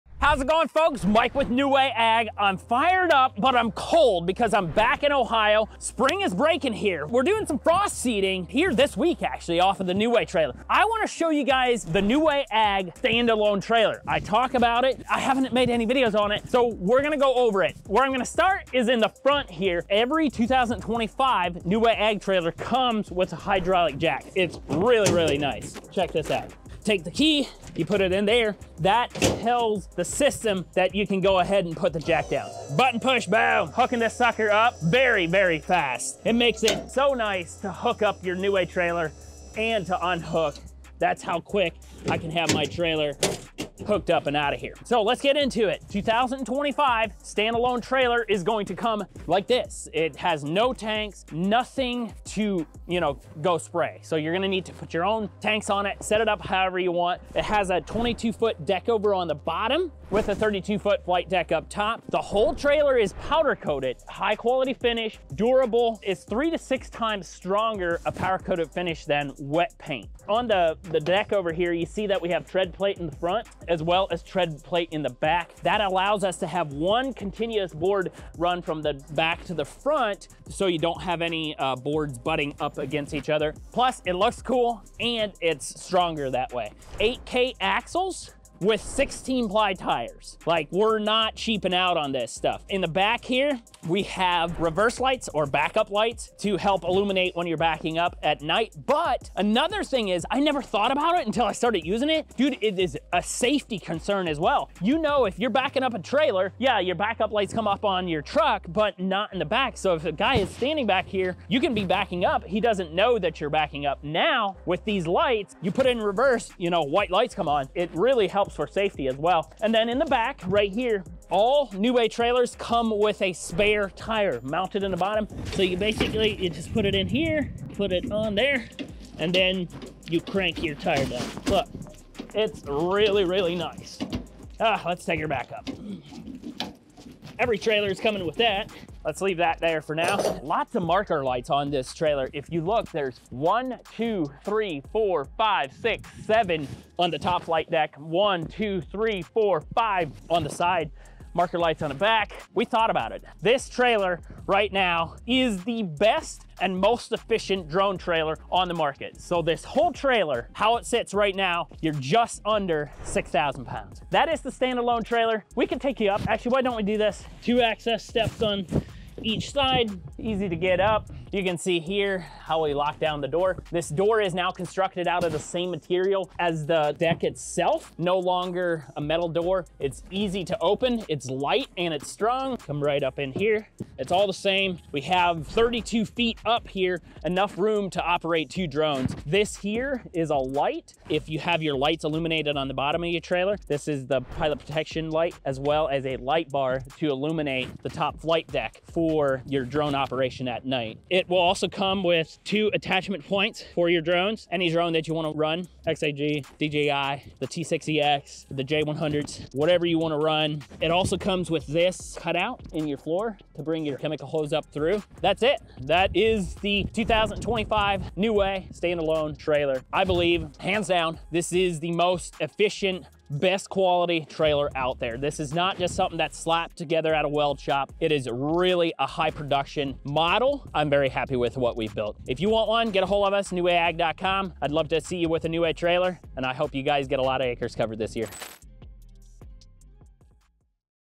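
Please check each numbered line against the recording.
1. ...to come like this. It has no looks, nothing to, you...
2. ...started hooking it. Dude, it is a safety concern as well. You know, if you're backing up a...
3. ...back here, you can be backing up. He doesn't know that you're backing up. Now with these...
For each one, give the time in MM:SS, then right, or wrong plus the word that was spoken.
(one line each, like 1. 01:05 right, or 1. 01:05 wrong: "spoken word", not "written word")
1. 00:48 wrong: "tanks", not "looks"
2. 01:41 wrong: "using", not "hooking"
3. 01:50 right.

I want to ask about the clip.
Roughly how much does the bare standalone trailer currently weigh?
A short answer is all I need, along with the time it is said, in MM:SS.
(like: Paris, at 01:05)
just under 6,000 pounds, at 02:41.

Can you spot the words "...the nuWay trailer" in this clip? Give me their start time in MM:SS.
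00:09.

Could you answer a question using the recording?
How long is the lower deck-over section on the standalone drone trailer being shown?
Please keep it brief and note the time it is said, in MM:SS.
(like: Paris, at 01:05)
22 feet, at 00:57.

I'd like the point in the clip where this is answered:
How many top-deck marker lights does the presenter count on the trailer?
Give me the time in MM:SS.
02:26.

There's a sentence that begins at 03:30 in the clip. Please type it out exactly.
It also comes with this cutout in your floor to bring your chemical hose up through.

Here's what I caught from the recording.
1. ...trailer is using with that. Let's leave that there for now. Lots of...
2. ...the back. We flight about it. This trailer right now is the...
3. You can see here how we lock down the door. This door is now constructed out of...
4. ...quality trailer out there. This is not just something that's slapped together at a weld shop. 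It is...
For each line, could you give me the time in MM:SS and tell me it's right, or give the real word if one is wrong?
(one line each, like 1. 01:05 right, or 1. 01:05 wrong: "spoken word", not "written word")
1. 02:17 wrong: "coming", not "using"
2. 02:31 wrong: "thought", not "flight"
3. 02:51 right
4. 03:43 right.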